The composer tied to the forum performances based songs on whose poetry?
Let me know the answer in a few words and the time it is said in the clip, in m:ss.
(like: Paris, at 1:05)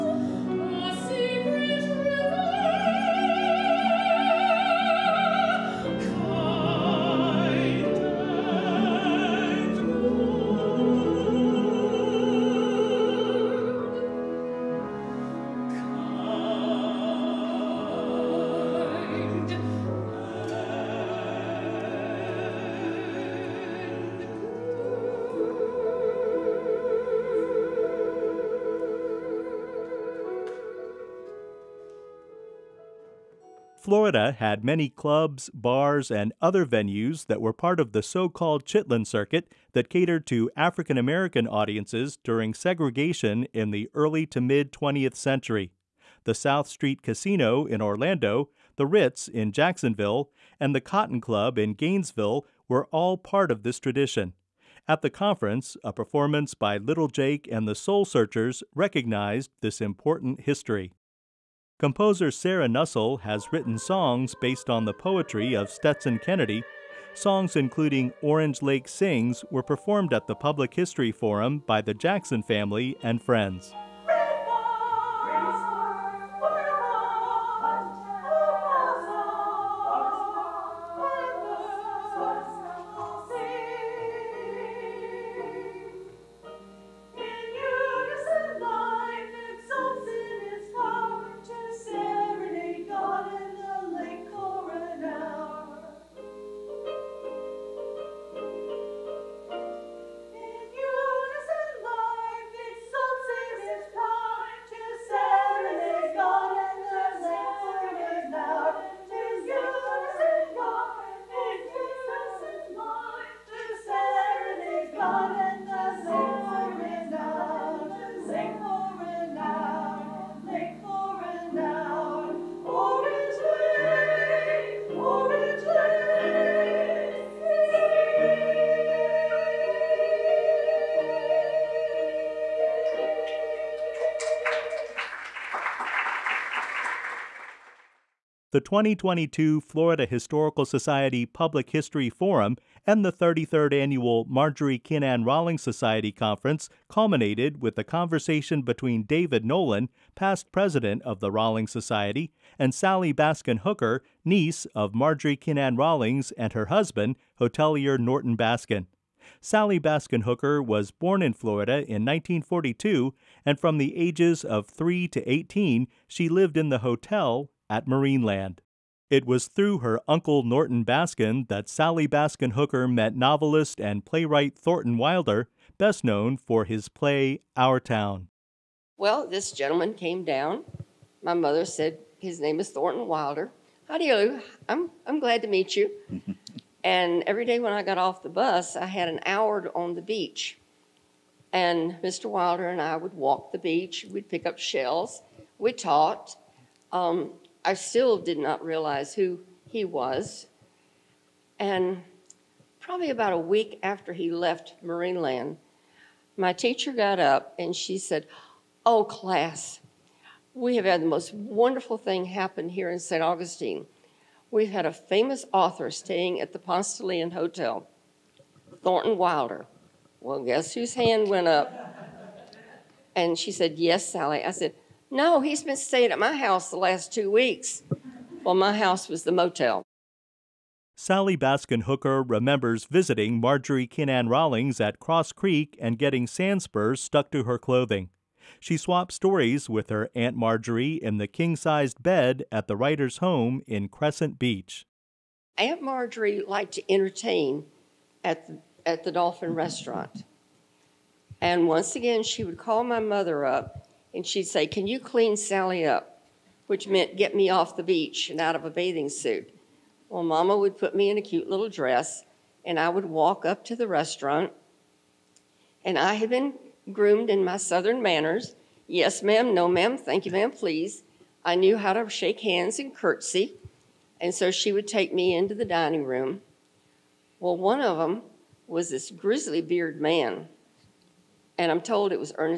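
Stetson Kennedy, at 1:05.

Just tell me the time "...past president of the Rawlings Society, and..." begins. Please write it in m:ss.
2:30.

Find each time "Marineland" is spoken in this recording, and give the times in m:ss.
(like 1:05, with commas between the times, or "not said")
2:47, 3:24.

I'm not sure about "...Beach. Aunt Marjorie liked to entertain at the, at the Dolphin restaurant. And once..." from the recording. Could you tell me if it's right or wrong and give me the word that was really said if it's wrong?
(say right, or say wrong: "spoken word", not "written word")
right.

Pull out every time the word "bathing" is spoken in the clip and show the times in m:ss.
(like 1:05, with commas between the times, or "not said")
4:18.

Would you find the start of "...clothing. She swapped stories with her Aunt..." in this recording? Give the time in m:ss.
3:57.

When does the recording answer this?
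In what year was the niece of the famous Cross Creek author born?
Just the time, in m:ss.
2:42.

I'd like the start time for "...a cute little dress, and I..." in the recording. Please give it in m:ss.
4:21.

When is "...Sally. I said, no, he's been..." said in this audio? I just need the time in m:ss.
3:44.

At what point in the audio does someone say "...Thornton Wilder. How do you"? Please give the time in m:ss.
3:02.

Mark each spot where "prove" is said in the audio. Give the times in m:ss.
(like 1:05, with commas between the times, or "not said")
not said.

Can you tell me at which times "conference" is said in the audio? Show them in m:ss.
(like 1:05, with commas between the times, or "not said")
0:55, 2:26.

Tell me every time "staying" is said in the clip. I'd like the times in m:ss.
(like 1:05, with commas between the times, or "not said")
3:35, 3:45.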